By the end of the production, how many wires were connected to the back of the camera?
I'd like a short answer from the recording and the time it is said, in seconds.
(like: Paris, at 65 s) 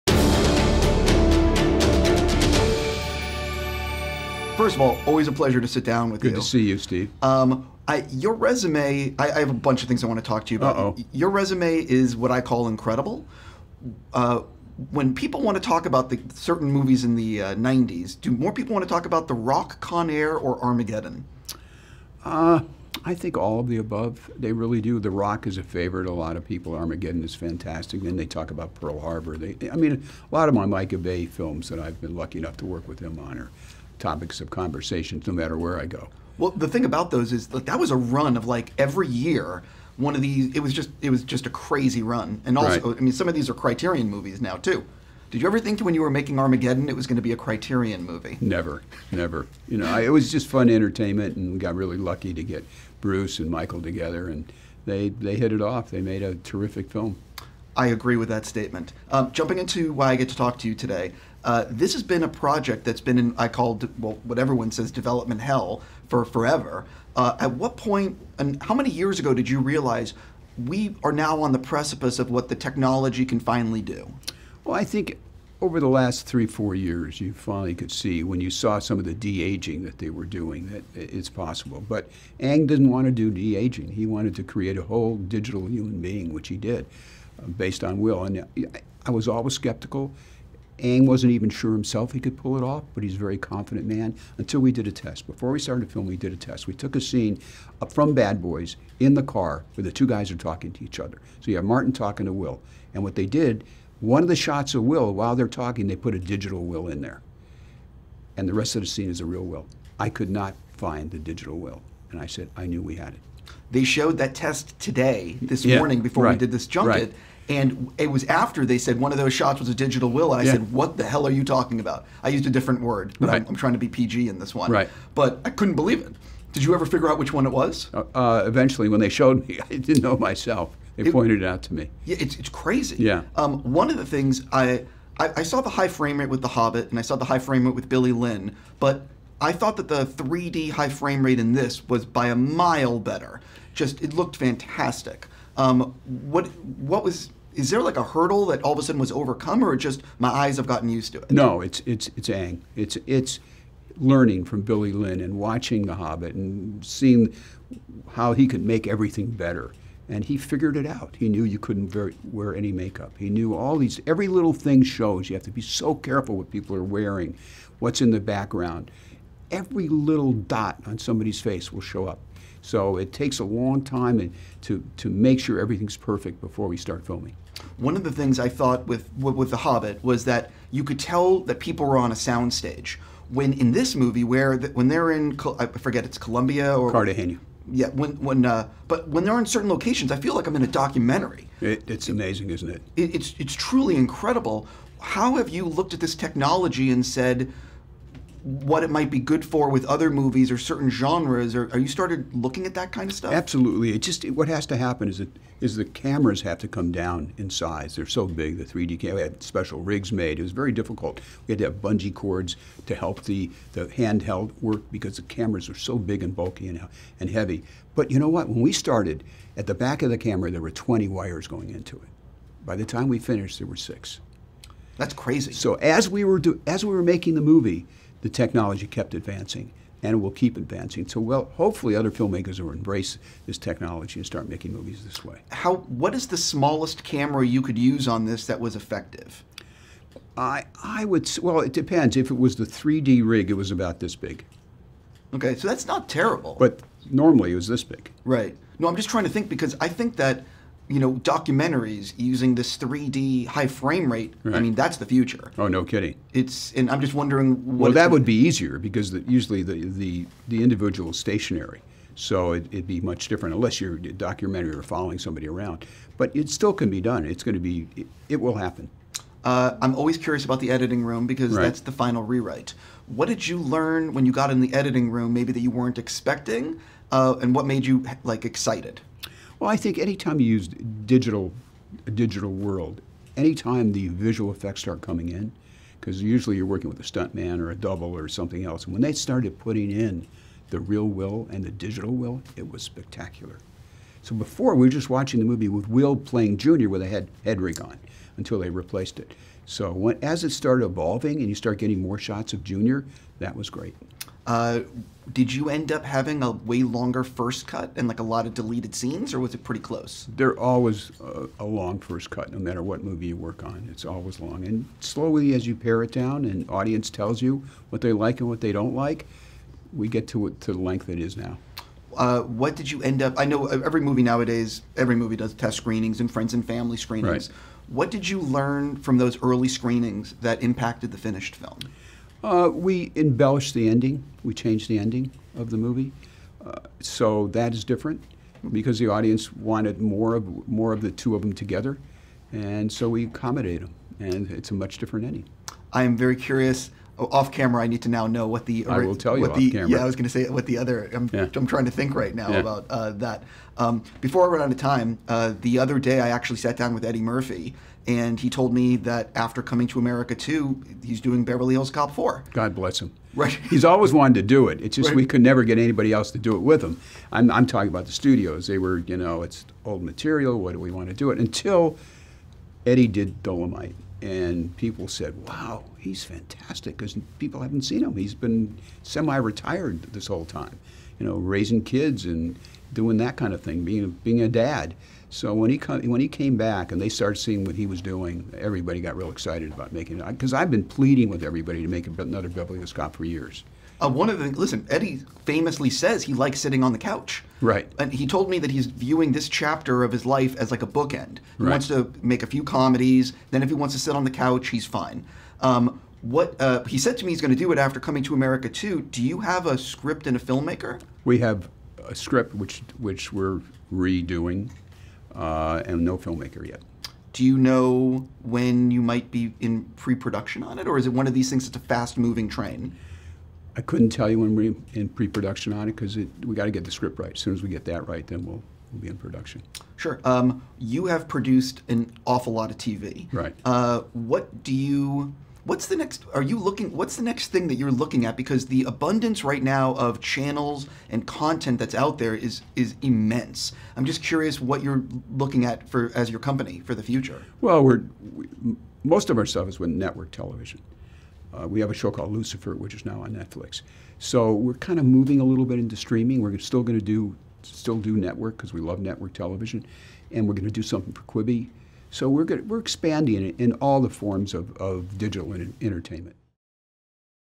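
6, at 223 s.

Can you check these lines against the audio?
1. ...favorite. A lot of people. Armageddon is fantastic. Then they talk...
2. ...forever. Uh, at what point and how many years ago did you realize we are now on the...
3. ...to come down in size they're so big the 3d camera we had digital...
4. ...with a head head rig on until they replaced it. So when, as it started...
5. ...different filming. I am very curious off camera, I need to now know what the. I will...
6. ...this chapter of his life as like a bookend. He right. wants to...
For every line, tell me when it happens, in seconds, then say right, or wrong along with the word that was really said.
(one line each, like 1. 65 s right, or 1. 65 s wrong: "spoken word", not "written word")
1. 25 s right
2. 66 s right
3. 206 s wrong: "special", not "digital"
4. 296 s right
5. 344 s wrong: "ending", not "filming"
6. 399 s right.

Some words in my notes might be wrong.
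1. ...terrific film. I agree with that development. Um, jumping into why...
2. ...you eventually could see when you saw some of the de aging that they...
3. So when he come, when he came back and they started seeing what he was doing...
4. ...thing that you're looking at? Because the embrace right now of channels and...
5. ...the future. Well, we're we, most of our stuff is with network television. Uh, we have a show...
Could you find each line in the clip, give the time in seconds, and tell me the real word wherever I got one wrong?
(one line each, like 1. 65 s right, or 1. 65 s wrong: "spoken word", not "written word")
1. 56 s wrong: "statement", not "development"
2. 77 s wrong: "finally", not "eventually"
3. 385 s right
4. 437 s wrong: "abundance", not "embrace"
5. 446 s right.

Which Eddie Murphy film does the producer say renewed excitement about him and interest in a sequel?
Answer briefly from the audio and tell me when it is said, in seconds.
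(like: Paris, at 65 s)
Dolomite, at 373 s.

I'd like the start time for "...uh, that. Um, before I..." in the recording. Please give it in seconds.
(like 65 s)
352 s.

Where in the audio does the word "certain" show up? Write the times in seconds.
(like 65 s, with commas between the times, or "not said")
16 s, 189 s, 200 s.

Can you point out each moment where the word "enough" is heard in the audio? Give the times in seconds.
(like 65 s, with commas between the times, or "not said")
32 s.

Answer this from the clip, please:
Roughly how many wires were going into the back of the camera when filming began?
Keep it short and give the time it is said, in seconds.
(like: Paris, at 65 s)
20, at 220 s.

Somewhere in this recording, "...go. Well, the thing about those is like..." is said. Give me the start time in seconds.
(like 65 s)
35 s.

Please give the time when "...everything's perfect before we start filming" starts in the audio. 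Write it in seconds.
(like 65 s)
175 s.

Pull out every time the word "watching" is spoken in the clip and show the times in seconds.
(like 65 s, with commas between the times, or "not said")
155 s, 295 s.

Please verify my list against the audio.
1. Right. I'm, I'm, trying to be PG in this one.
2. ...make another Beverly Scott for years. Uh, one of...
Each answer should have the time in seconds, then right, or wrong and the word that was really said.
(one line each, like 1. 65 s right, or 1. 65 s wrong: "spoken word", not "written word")
1. 123 s right
2. 391 s right.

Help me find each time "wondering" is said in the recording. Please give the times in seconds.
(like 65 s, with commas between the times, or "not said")
257 s.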